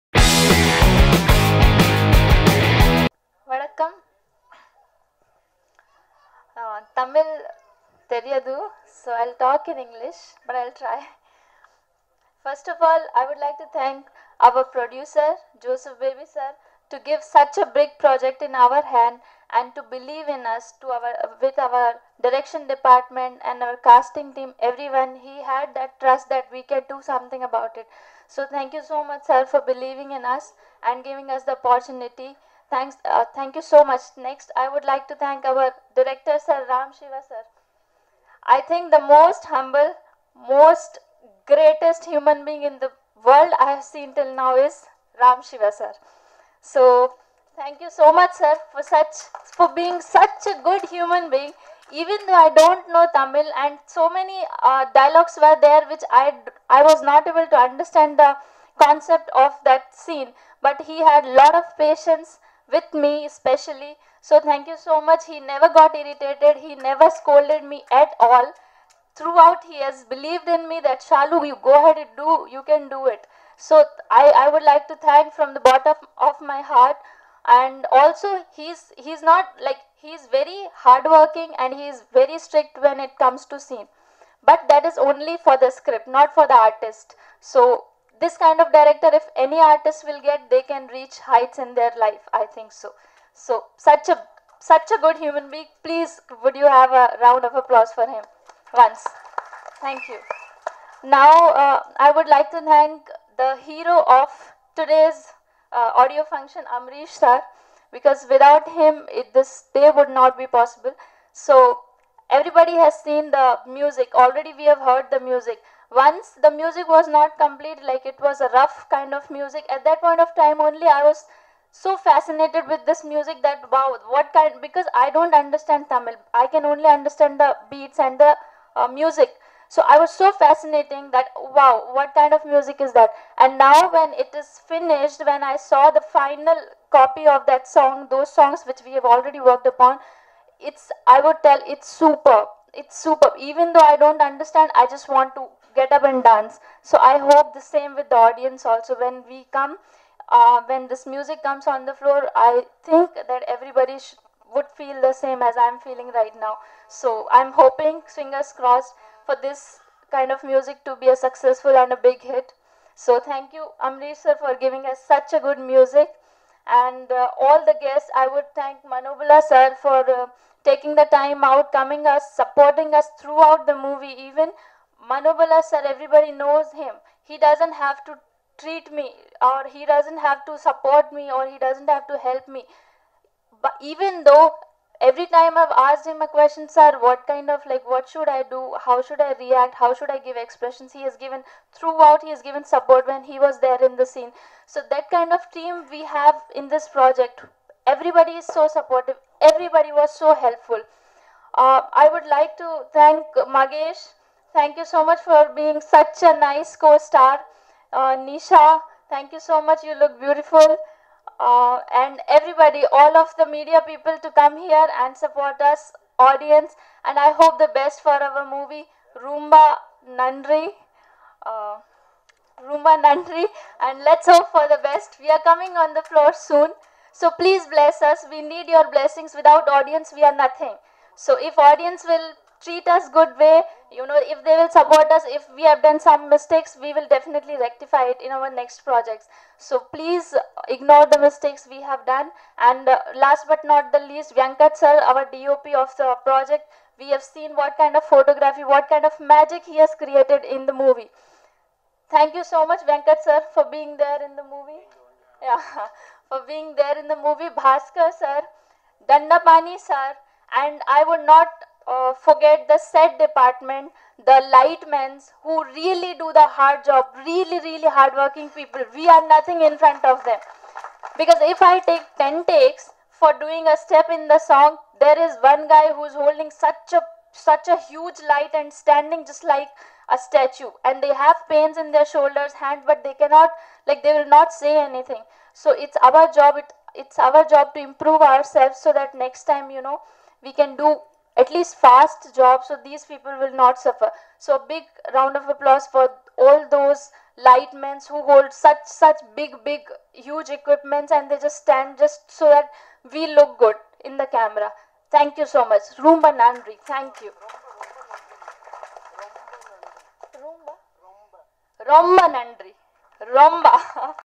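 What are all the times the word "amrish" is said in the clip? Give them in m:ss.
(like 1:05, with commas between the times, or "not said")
1:46, 2:43.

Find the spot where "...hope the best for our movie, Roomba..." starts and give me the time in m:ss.
3:37.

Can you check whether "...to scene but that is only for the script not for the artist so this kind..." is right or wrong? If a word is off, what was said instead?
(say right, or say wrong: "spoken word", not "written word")
right.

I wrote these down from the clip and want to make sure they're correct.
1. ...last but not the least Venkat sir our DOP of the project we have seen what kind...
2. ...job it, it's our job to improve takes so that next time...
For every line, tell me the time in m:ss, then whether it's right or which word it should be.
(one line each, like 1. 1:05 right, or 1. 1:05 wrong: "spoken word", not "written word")
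1. 4:03 right
2. 4:46 wrong: "ourselves", not "takes".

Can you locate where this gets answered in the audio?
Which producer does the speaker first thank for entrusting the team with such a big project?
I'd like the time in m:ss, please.
0:15.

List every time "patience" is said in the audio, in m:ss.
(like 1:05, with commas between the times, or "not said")
1:01.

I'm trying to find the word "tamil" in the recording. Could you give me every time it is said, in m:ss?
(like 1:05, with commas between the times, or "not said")
0:07, 0:53, 2:05.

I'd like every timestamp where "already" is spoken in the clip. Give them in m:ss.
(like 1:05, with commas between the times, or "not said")
1:54, 2:19.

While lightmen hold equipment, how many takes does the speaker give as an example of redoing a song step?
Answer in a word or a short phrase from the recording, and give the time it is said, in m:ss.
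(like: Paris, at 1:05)
10, at 4:32.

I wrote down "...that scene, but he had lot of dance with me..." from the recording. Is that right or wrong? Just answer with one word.
wrong.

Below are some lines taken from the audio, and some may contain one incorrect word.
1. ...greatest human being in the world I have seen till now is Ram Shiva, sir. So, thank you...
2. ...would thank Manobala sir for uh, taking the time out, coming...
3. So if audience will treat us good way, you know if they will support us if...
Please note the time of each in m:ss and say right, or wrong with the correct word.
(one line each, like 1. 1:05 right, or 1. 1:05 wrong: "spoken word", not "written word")
1. 0:41 right
2. 2:48 right
3. 3:51 right.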